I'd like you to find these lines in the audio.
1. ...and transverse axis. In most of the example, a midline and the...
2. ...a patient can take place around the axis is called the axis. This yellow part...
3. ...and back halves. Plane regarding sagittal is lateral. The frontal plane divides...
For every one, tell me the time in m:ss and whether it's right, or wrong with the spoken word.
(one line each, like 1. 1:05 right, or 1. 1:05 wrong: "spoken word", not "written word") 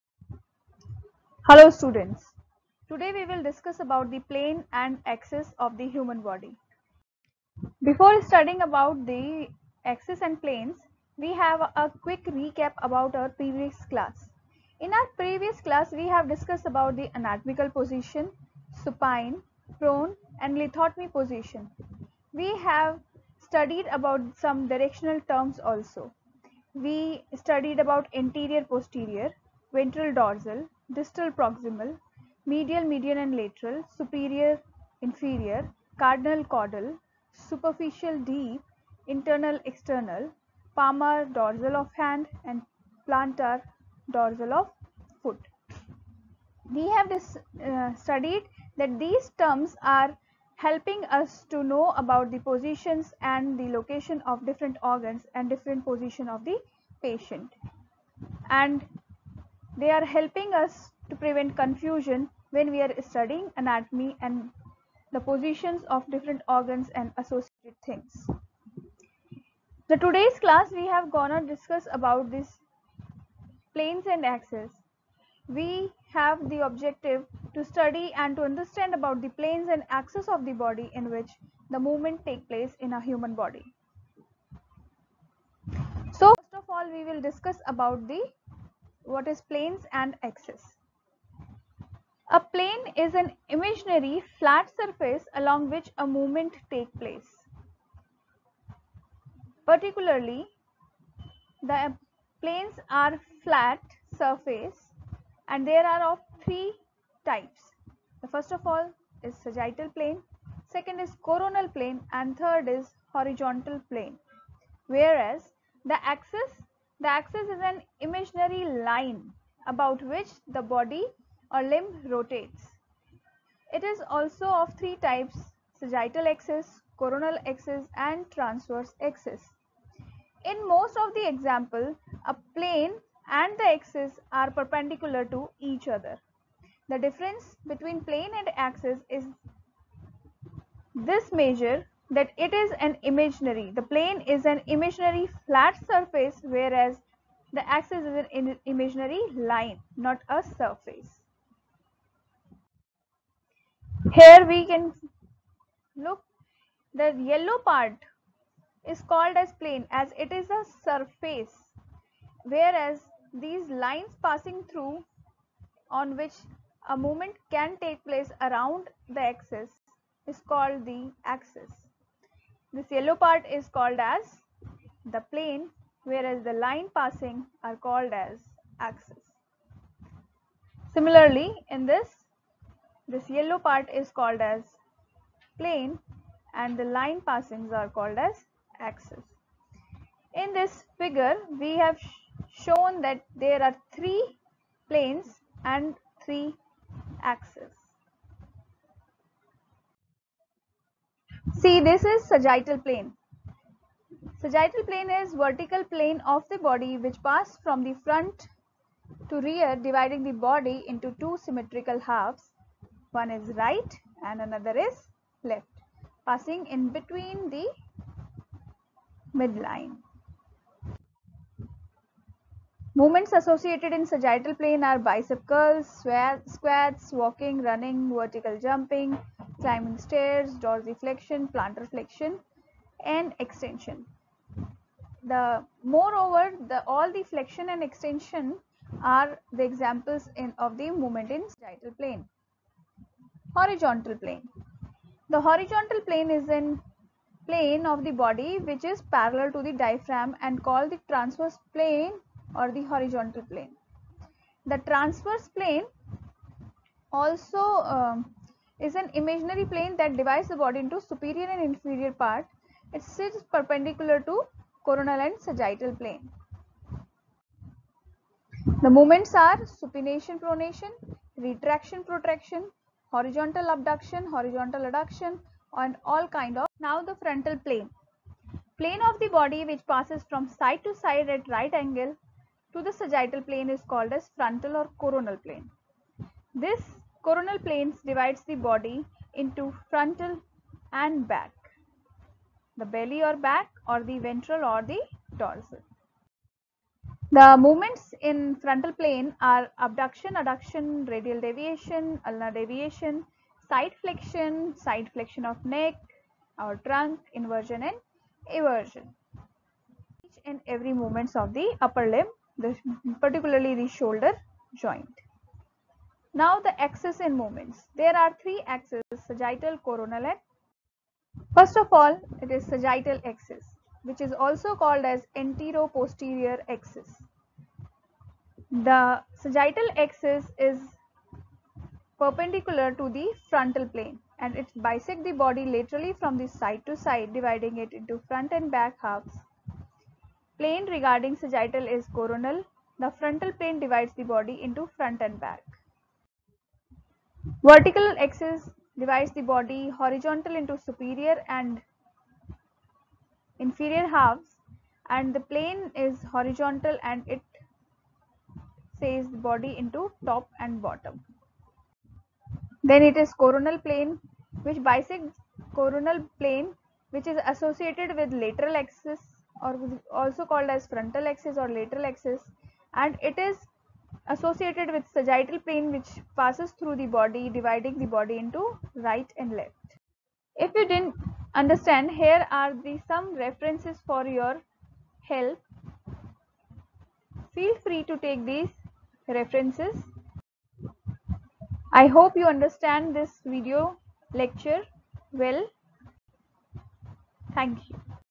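1. 2:07 wrong: "plane", not "midline"
2. 2:46 wrong: "movement", not "patient"
3. 5:38 wrong: "coronal", not "lateral".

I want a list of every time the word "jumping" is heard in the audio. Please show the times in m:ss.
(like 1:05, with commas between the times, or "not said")
3:48.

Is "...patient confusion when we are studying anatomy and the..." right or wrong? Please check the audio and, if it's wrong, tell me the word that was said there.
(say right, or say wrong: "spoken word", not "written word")
wrong: "prevent", not "patient".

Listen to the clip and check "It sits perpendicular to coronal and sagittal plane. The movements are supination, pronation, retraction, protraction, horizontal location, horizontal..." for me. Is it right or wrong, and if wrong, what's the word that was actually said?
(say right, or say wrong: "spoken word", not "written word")
wrong: "abduction", not "location".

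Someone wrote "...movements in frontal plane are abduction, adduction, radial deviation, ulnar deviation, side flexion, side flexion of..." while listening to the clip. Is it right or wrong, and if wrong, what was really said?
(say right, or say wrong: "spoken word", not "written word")
right.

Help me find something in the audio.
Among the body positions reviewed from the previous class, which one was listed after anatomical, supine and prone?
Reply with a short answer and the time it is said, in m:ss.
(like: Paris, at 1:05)
Lithotomy, at 0:20.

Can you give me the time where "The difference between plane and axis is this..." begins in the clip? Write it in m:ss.
2:16.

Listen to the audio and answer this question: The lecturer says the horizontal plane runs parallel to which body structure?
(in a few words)
Diaphragm.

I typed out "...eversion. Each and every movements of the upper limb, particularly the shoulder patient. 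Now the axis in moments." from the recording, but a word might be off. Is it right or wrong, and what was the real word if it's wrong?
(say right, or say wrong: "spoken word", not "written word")
wrong: "joint", not "patient".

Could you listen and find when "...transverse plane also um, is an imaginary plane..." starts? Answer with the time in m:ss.
4:14.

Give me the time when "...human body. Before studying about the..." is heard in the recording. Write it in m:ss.
0:05.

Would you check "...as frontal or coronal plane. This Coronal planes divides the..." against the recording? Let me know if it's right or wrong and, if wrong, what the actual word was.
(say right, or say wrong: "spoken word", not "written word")
right.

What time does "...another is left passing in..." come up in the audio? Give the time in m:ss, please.
3:34.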